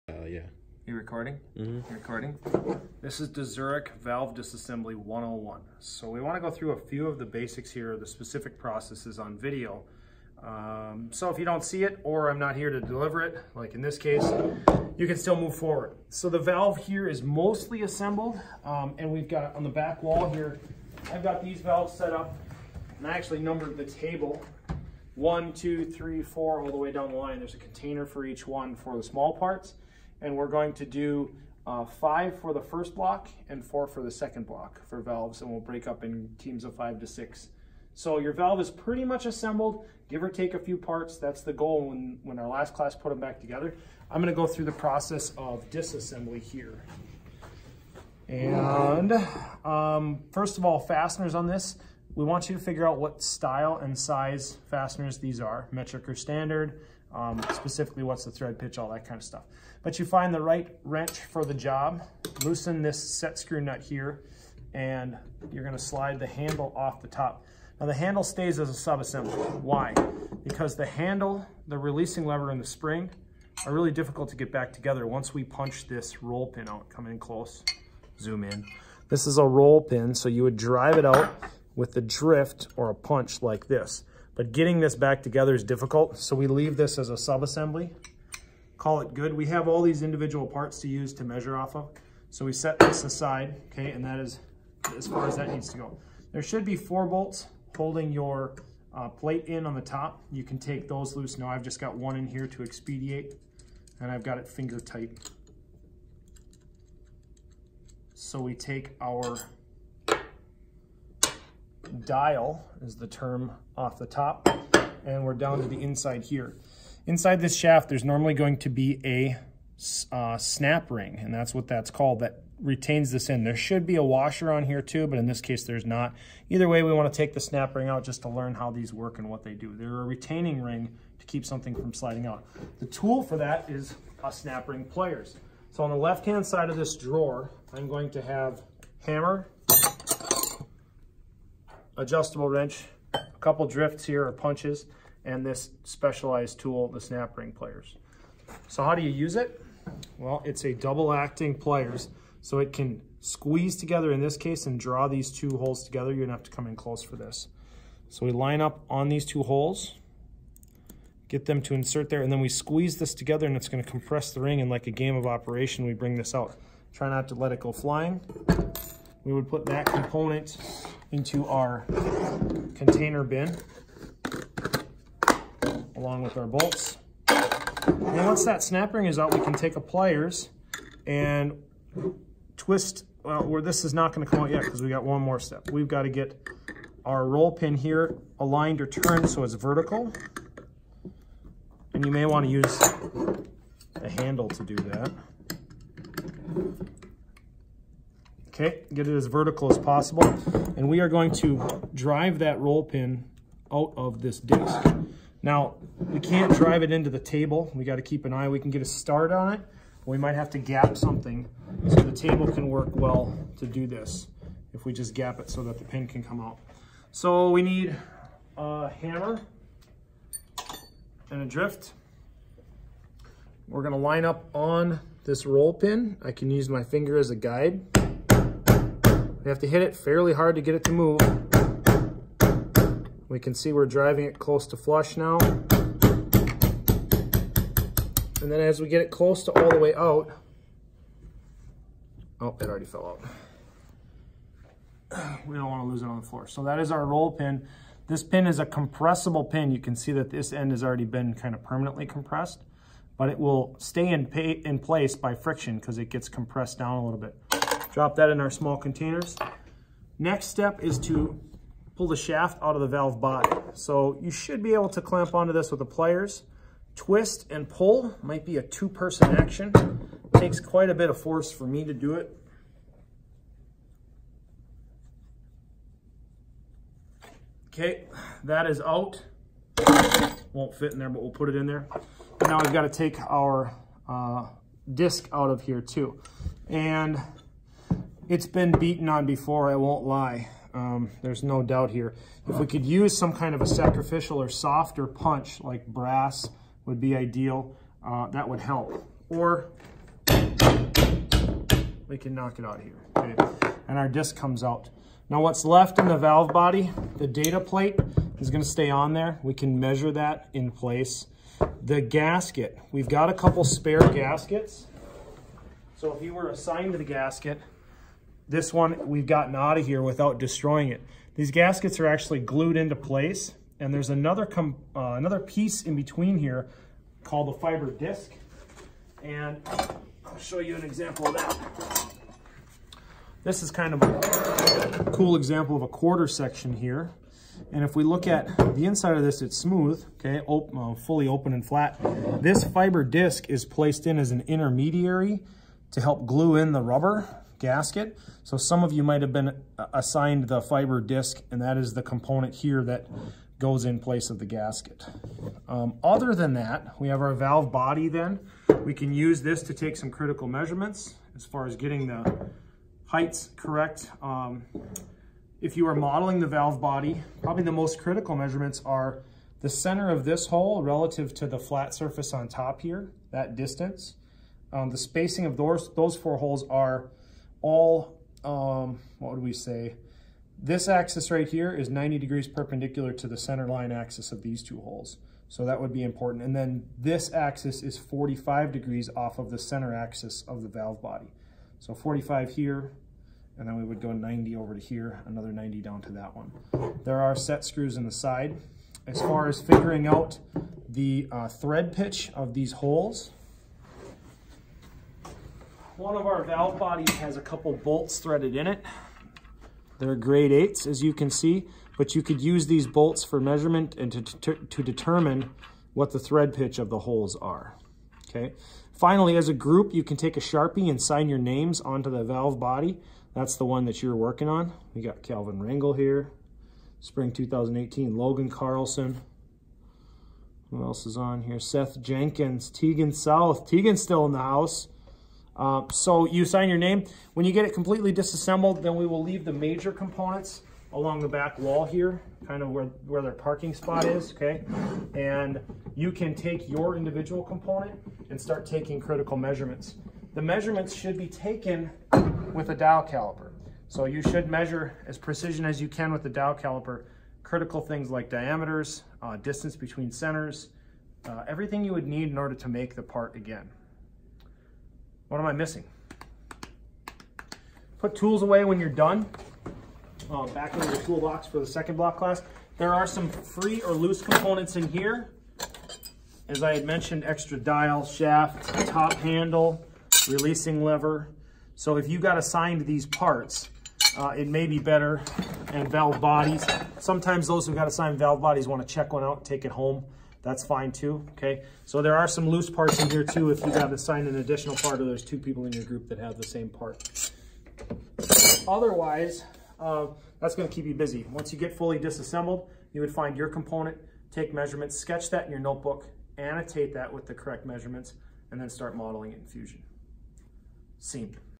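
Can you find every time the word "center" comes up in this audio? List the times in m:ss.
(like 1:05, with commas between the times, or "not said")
6:09, 6:23, 6:29, 7:40.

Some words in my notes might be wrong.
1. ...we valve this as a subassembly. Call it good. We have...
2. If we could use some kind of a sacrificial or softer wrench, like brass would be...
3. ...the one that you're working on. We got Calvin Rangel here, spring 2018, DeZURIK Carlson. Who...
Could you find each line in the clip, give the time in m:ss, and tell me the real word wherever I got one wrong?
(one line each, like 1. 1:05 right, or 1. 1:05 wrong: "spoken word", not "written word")
1. 1:26 wrong: "leave", not "valve"
2. 4:52 wrong: "punch", not "wrench"
3. 7:03 wrong: "Logan", not "DeZURIK".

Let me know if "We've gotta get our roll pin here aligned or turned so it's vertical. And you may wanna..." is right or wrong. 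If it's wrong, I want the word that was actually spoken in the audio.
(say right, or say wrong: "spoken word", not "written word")
right.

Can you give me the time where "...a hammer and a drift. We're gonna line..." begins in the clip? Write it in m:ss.
3:38.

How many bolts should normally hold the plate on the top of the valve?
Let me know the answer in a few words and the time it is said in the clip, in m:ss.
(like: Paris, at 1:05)
4, at 1:36.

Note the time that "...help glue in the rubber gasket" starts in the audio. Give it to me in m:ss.
5:46.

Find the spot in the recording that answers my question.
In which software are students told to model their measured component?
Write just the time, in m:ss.
8:29.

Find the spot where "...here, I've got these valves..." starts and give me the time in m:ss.
0:20.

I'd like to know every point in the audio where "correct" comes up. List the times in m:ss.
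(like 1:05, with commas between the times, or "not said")
6:03, 8:27.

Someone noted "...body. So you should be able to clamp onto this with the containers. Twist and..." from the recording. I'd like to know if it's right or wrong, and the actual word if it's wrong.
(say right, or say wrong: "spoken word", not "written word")
wrong: "pliers", not "containers".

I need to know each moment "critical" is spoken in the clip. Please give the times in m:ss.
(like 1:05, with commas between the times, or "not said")
6:00, 6:07, 7:28, 7:37.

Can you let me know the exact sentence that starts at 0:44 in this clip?
I'm gonna go through the process of disassembly here.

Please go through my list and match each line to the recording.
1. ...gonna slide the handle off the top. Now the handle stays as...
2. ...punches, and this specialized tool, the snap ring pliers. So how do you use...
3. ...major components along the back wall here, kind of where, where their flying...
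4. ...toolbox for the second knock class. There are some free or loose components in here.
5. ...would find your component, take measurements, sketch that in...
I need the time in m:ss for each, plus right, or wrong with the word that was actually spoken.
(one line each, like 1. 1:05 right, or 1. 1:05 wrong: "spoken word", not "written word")
1. 1:05 right
2. 2:24 right
3. 7:19 wrong: "parking", not "flying"
4. 7:50 wrong: "block", not "knock"
5. 8:23 right.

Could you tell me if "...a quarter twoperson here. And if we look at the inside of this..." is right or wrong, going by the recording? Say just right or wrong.
wrong.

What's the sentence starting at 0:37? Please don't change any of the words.
So your valve is pretty much assembled, give or take a few parts.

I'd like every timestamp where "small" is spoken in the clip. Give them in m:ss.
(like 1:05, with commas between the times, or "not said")
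0:29, 4:18.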